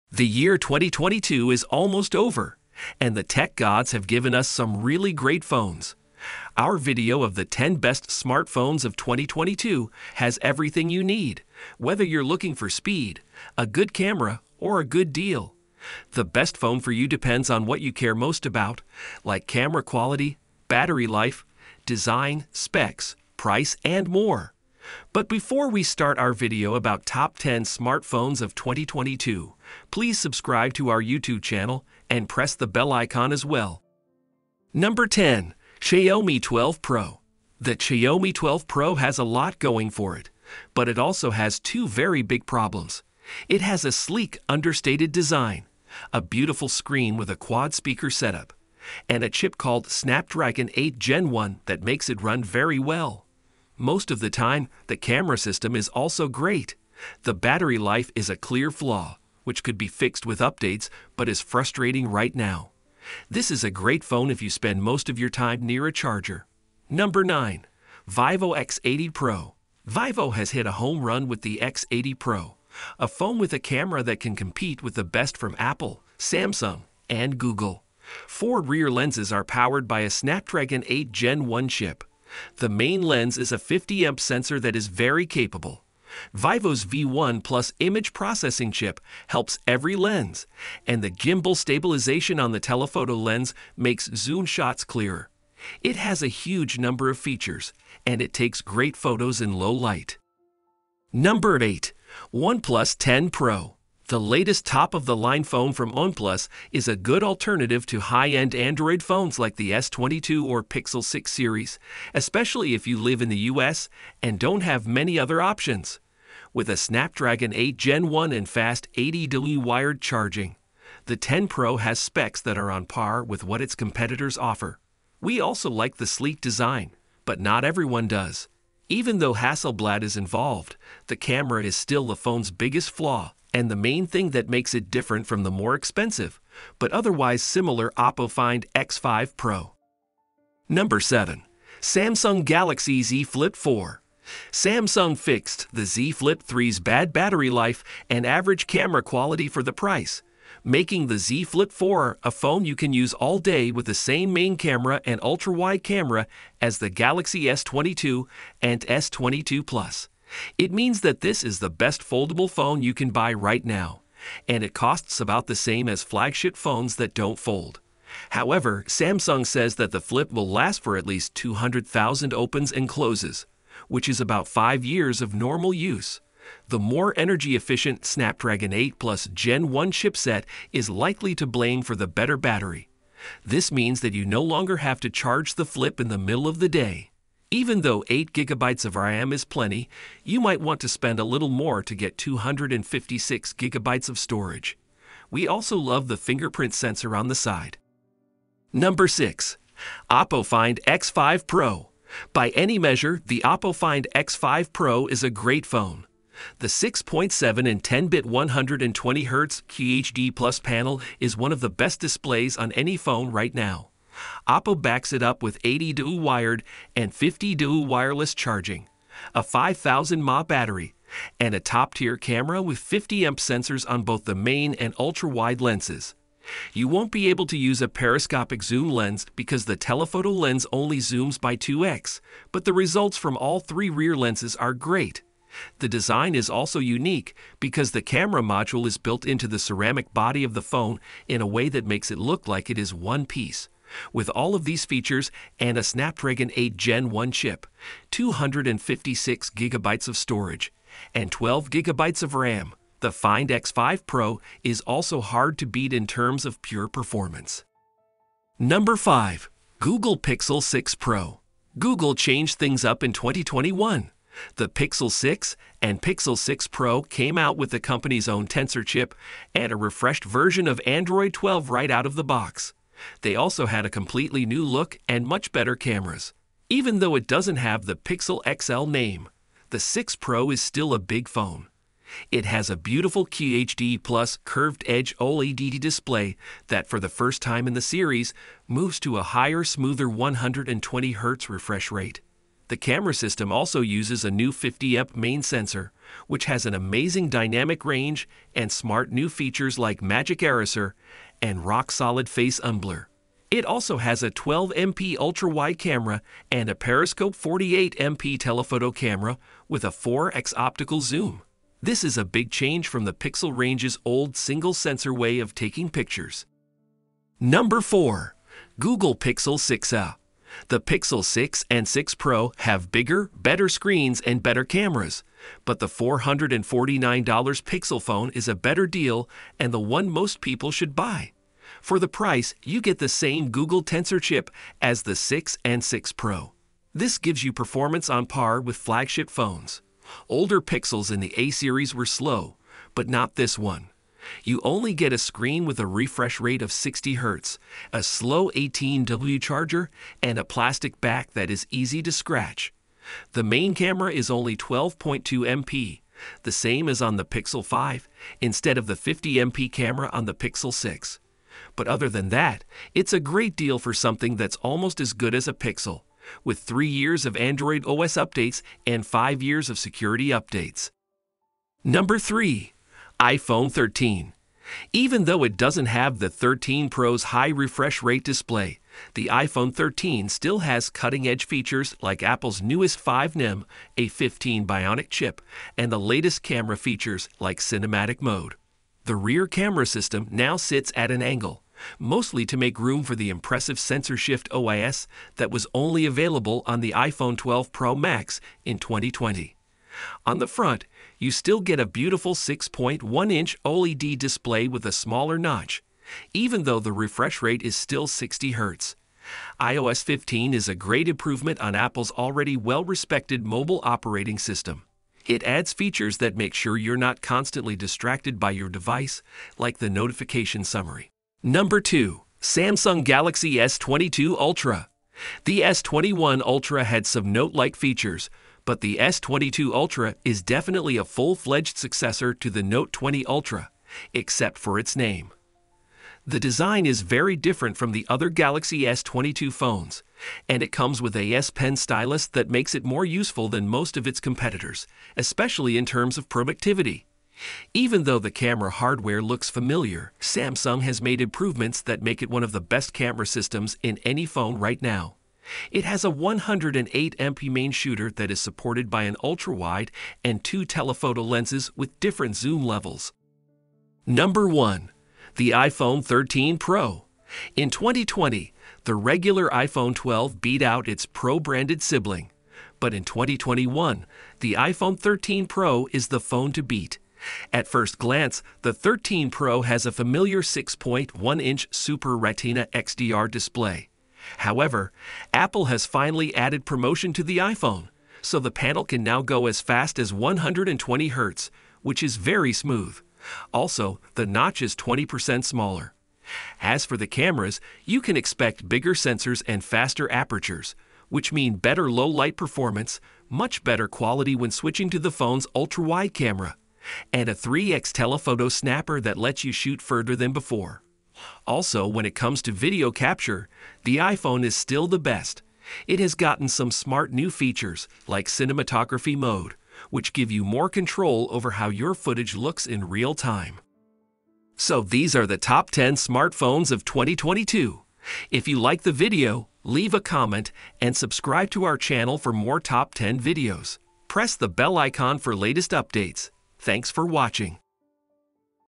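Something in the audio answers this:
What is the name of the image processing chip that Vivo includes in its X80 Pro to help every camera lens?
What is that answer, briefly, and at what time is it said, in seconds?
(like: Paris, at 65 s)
V1 Plus, at 86 s.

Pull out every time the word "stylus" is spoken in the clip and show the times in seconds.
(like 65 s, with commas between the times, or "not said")
441 s.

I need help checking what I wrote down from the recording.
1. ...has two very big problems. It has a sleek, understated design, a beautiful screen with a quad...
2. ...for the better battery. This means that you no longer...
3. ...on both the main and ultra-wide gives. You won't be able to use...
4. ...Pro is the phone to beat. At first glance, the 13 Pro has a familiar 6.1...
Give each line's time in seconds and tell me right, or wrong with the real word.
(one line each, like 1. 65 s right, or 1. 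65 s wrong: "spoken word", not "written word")
1. 41 s right
2. 181 s right
3. 223 s wrong: "lenses", not "gives"
4. 475 s right.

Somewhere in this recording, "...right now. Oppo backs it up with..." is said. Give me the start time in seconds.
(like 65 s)
213 s.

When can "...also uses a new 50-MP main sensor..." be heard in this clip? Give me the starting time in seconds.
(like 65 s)
293 s.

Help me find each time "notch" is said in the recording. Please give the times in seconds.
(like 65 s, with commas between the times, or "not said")
405 s, 494 s.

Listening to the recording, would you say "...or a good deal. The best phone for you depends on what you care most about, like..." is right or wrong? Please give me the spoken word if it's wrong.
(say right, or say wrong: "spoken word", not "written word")
right.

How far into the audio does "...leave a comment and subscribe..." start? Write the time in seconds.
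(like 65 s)
529 s.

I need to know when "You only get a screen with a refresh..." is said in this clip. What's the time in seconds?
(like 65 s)
344 s.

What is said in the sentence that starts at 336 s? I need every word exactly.
This gives you performance on par with flagship phones.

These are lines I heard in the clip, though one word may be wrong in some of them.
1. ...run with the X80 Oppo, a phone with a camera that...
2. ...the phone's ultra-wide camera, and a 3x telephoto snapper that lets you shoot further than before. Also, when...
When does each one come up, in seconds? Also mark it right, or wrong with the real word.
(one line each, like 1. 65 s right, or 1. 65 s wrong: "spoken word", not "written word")
1. 71 s wrong: "Pro", not "Oppo"
2. 504 s right.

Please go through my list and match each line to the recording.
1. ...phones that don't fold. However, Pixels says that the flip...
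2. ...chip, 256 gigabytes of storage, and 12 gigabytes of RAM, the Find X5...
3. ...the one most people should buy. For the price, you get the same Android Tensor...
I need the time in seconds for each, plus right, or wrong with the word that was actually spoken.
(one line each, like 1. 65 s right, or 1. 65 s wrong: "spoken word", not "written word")
1. 166 s wrong: "Samsung", not "Pixels"
2. 247 s right
3. 329 s wrong: "Google", not "Android".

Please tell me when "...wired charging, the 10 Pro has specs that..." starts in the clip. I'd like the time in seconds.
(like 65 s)
119 s.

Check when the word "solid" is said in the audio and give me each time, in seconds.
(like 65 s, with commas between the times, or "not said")
301 s.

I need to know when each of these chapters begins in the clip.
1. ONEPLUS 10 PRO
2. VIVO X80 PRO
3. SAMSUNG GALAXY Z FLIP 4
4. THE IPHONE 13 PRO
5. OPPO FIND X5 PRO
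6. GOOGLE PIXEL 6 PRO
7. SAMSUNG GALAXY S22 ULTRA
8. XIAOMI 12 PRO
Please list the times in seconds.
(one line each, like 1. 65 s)
1. 102 s
2. 68 s
3. 141 s
4. 465 s
5. 200 s
6. 259 s
7. 423 s
8. 36 s.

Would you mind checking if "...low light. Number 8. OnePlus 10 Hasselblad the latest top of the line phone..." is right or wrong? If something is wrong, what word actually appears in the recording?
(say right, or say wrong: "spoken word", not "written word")
wrong: "Pro", not "Hasselblad".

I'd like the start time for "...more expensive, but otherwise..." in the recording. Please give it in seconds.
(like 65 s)
135 s.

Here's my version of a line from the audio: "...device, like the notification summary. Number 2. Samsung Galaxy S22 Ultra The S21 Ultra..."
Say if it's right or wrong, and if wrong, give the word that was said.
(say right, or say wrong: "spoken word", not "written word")
right.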